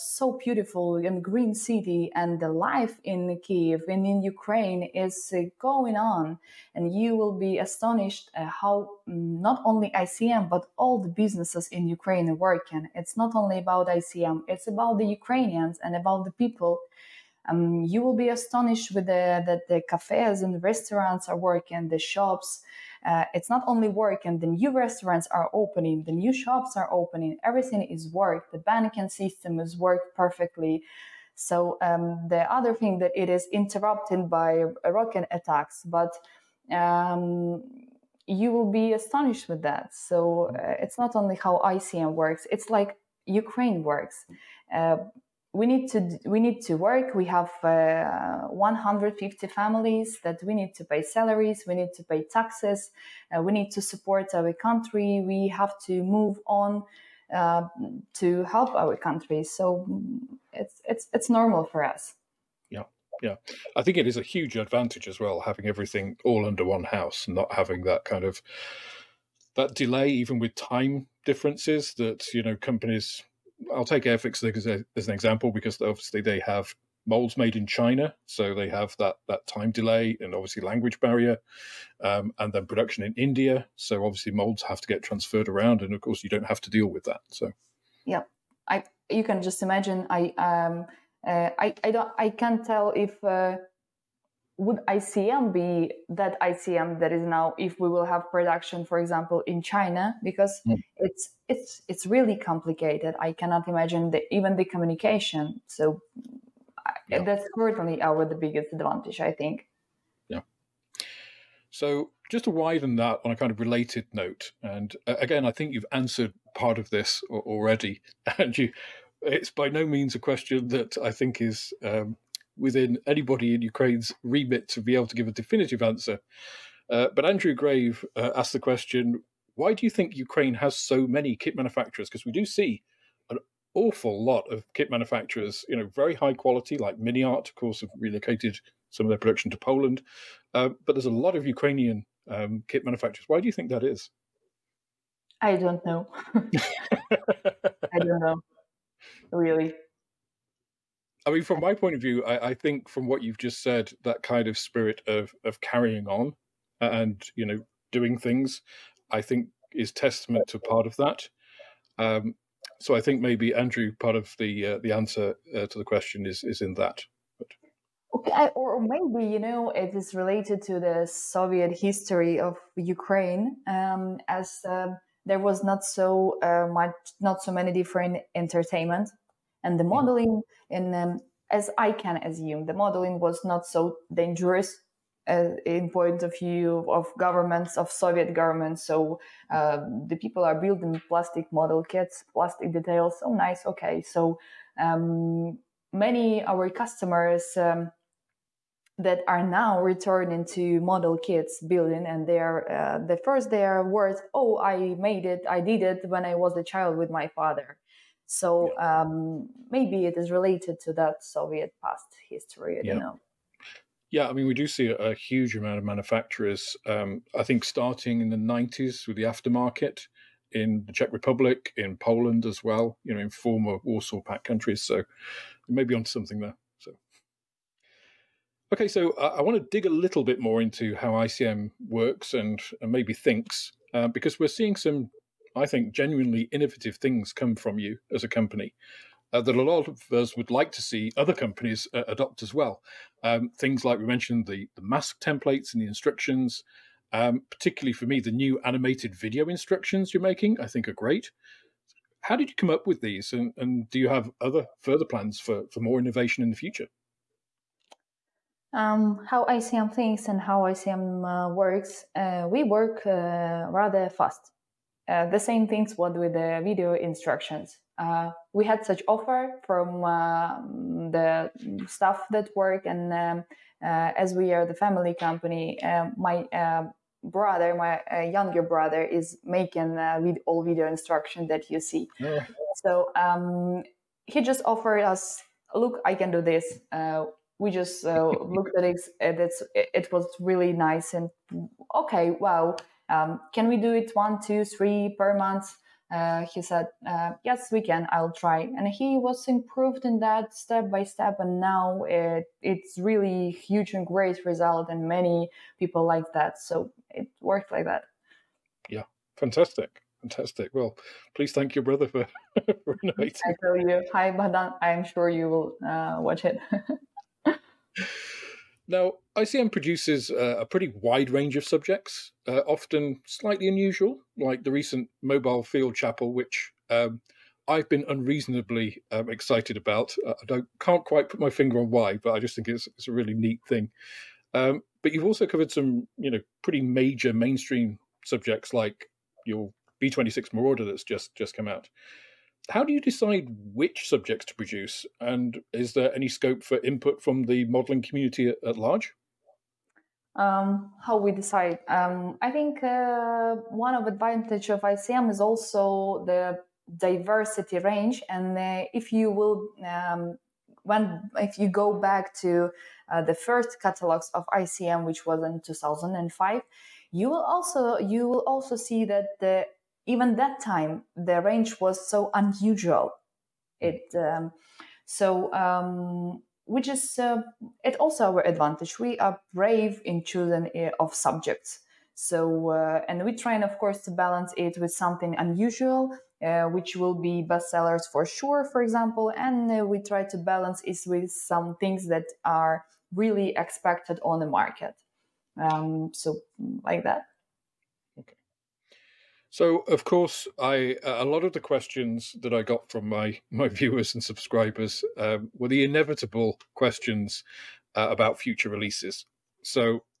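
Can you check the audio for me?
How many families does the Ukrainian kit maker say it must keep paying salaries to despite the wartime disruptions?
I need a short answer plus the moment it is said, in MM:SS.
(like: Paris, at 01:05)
150, at 00:48.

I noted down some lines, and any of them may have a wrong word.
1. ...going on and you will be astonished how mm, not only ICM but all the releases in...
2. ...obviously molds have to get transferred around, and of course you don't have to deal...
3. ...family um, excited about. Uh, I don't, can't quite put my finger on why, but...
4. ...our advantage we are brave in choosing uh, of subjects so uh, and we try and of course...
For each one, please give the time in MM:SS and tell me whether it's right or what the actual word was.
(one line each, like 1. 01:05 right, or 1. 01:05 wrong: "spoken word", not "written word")
1. 00:05 wrong: "businesses", not "releases"
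2. 01:24 right
3. 05:28 wrong: "unreasonably", not "family"
4. 06:18 right.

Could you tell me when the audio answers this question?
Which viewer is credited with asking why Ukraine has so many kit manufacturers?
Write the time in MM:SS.
02:07.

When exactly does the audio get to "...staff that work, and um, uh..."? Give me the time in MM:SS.
04:31.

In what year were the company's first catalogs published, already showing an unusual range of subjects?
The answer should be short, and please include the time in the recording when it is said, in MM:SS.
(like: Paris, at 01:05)
2005, at 06:05.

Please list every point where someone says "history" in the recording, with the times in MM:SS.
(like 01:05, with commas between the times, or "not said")
02:51, 03:32.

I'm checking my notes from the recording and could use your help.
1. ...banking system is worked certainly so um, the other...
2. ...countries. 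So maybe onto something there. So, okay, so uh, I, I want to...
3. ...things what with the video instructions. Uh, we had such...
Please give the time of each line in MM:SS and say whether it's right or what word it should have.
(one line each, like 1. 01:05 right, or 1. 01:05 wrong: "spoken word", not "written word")
1. 00:28 wrong: "perfectly", not "certainly"
2. 03:44 right
3. 04:25 right.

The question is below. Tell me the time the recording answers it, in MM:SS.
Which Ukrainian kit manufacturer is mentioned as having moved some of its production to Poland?
02:16.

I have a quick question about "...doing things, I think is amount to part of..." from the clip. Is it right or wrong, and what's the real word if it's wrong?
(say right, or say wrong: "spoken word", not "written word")
wrong: "testament", not "amount".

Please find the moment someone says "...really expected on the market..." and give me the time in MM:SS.
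06:33.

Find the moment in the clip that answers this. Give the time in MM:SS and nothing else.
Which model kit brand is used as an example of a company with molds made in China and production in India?
01:14.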